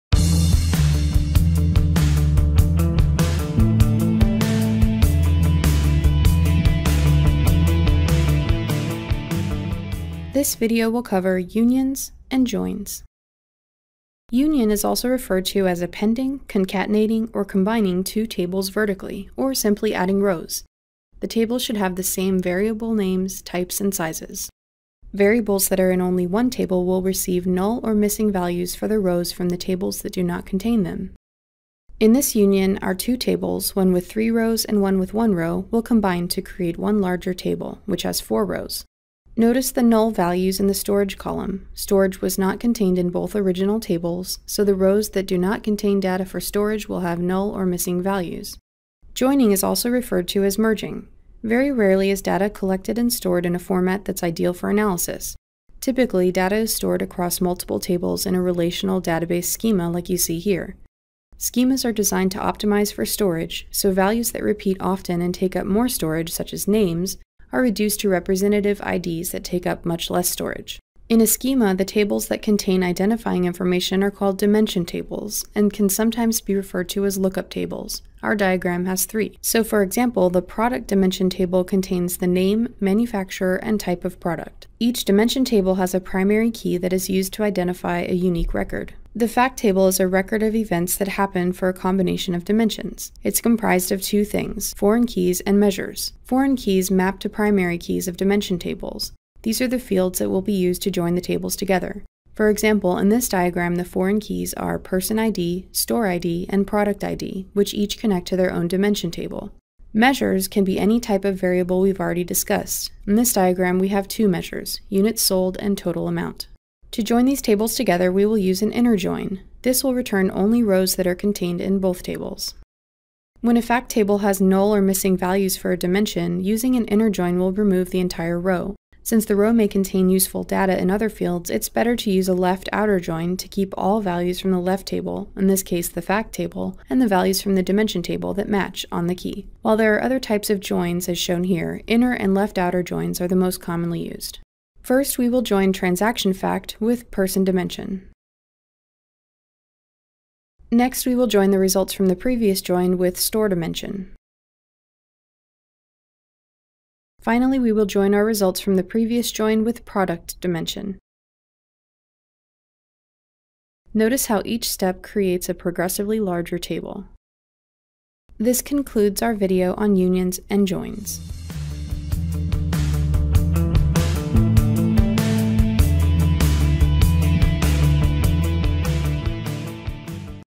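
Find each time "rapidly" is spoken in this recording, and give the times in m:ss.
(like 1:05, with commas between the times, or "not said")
not said.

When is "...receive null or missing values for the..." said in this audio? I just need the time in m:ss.
0:27.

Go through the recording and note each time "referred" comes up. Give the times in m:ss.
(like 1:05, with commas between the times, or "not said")
0:15, 0:49, 1:16.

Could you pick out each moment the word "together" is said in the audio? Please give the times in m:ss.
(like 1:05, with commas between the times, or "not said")
1:41, 1:57.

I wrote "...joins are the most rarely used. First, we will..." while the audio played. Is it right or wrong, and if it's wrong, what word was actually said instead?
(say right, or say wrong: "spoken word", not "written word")
wrong: "commonly", not "rarely".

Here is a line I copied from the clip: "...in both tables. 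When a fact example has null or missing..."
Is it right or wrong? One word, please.
wrong.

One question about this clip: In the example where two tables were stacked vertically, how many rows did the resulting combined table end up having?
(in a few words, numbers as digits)
4.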